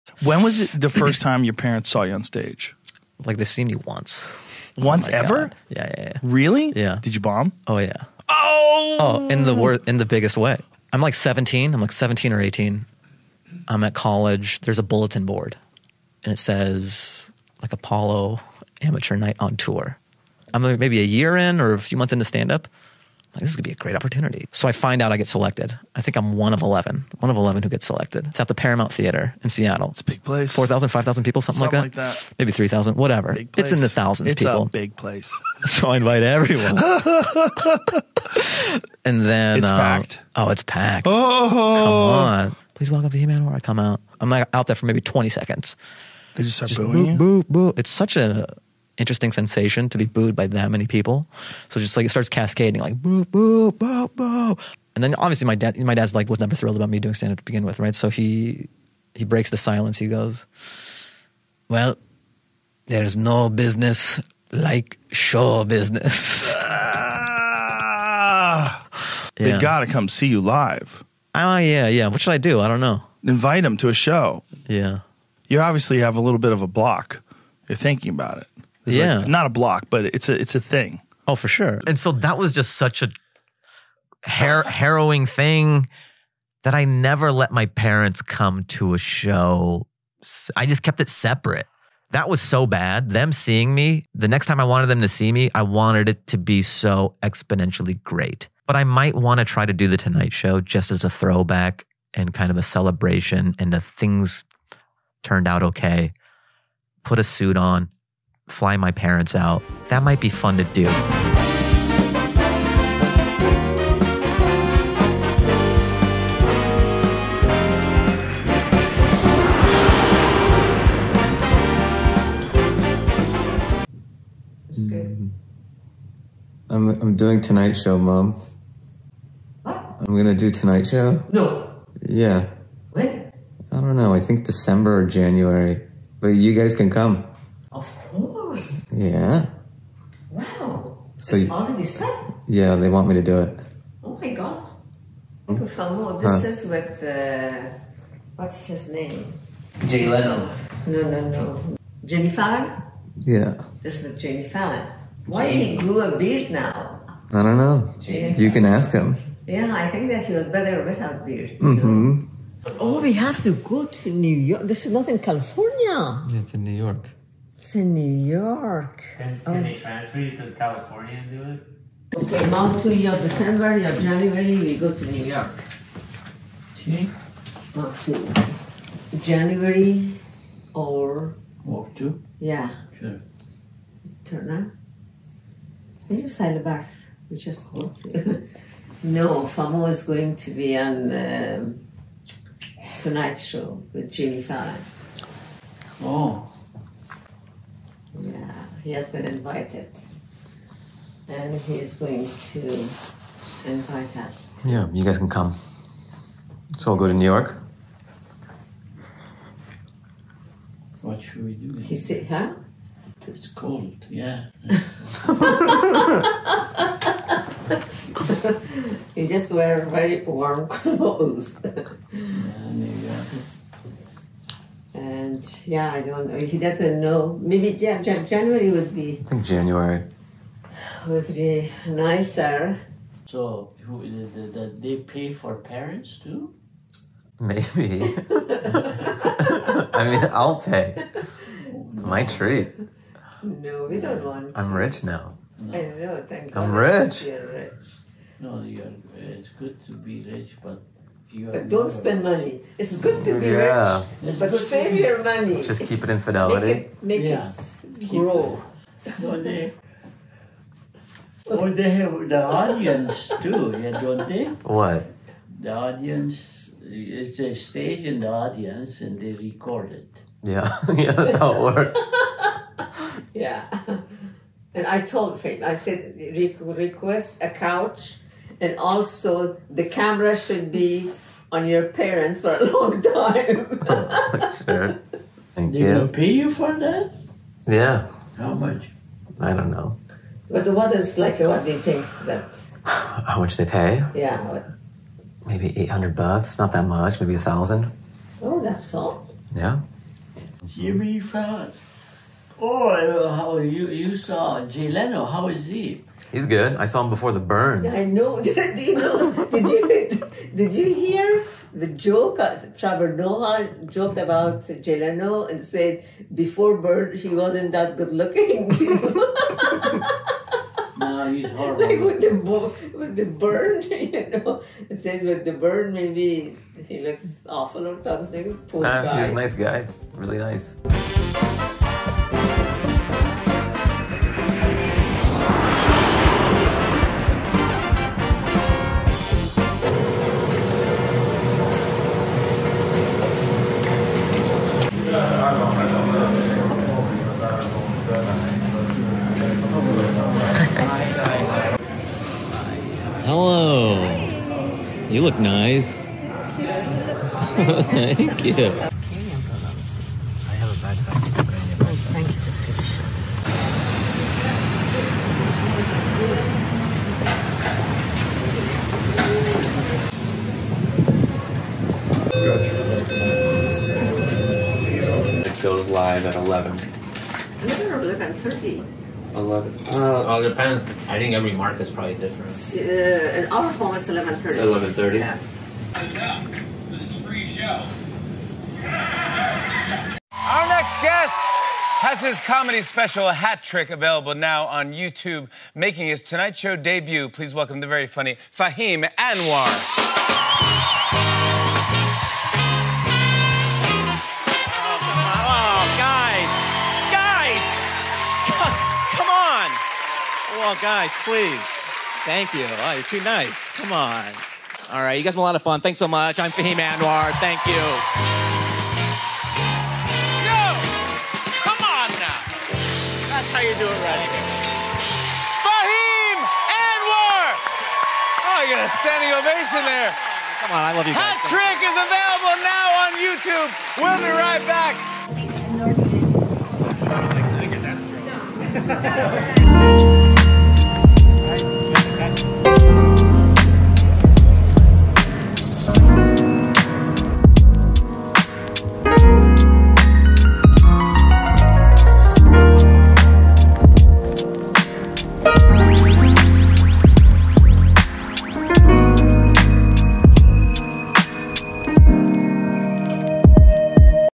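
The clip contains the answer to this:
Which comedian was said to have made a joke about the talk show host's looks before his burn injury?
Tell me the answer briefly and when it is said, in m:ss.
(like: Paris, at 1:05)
Trevor Noah, at 5:12.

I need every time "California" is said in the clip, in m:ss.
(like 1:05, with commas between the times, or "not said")
2:45, 2:50.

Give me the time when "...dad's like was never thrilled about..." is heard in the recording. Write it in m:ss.
0:55.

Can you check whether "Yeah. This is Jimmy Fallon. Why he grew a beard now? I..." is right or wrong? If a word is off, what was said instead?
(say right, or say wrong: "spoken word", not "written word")
right.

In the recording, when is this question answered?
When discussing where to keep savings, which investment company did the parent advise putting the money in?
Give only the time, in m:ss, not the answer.
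4:16.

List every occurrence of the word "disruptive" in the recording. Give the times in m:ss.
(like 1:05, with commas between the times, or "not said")
not said.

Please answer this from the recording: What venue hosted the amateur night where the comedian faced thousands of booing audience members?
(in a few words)
Paramount Theater.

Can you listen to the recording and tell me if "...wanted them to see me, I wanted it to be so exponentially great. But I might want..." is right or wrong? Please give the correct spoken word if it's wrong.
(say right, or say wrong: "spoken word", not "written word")
right.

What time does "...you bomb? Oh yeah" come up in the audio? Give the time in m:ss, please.
0:07.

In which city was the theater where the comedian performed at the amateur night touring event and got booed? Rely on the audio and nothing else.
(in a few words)
Seattle.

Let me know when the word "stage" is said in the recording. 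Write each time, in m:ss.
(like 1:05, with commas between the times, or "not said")
0:02, 4:27.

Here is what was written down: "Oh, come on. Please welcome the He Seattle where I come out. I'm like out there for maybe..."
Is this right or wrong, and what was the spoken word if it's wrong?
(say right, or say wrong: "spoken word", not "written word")
wrong: "Man", not "Seattle".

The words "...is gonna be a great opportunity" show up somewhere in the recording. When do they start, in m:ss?
0:23.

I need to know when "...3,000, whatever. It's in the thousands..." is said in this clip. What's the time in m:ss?
0:32.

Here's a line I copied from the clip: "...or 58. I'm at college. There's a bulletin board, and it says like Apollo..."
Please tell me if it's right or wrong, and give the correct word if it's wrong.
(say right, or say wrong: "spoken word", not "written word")
wrong: "18", not "58".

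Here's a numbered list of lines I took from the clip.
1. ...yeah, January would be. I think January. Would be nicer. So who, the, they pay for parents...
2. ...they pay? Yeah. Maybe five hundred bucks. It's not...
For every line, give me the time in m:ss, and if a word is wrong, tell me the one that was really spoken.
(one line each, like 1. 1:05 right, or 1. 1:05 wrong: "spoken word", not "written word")
1. 3:47 right
2. 4:53 wrong: "eight", not "five".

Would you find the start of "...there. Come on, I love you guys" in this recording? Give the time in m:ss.
7:09.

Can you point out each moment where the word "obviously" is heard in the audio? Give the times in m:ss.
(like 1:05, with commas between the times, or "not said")
0:55, 1:15.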